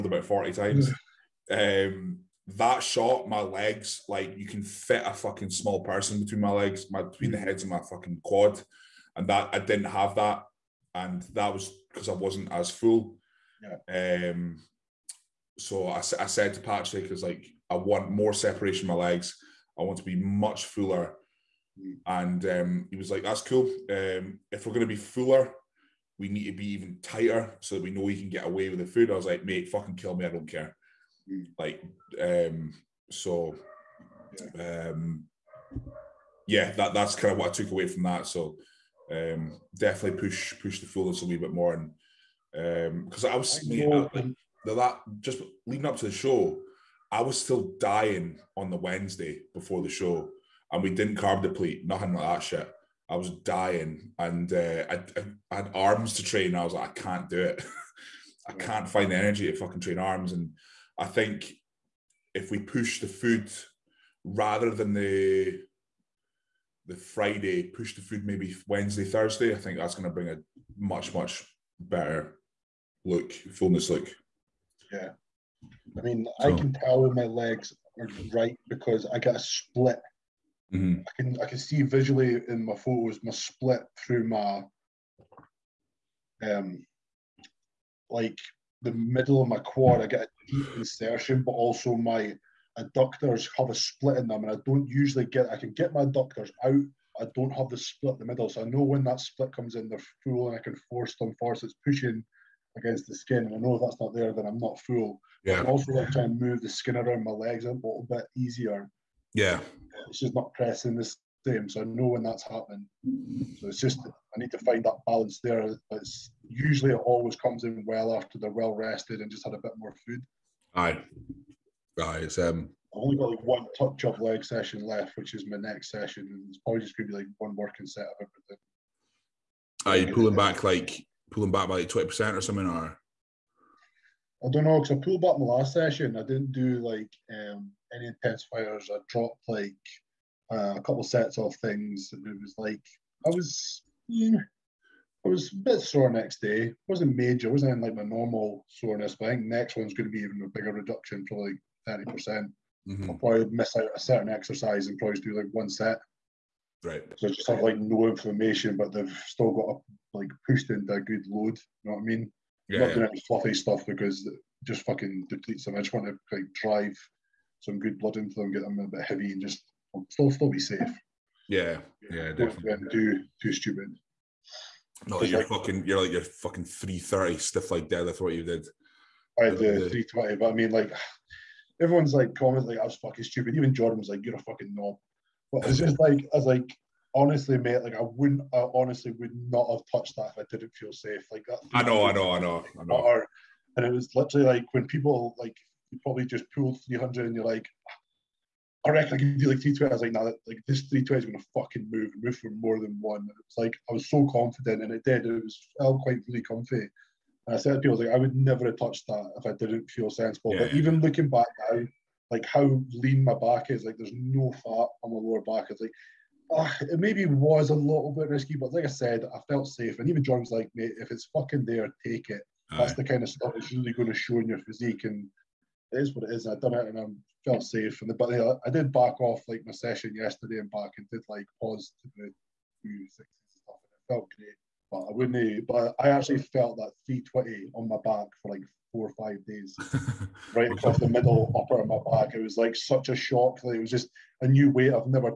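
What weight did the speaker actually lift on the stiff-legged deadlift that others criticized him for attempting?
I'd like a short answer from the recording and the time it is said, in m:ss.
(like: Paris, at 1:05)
320, at 2:59.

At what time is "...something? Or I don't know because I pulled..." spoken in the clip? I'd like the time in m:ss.
2:12.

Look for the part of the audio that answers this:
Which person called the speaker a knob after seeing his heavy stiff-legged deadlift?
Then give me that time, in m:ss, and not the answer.
3:03.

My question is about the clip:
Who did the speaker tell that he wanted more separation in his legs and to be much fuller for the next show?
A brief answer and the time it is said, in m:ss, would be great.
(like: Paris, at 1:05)
Patrick, at 0:16.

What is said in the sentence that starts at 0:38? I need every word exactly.
So, um, definitely push push the fullness a little bit more.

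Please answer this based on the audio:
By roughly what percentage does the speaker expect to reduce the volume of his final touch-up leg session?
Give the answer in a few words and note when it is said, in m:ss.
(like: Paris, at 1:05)
30%, at 2:31.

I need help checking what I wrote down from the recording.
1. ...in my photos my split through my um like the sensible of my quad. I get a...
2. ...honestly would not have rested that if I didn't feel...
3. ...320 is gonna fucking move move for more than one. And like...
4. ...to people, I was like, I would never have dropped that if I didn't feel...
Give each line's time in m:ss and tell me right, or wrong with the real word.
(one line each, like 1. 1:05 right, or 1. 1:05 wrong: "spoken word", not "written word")
1. 1:22 wrong: "middle", not "sensible"
2. 3:08 wrong: "touched", not "rested"
3. 3:20 right
4. 3:27 wrong: "touched", not "dropped".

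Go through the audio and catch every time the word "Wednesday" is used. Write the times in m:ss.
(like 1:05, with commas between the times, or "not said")
0:48, 1:08.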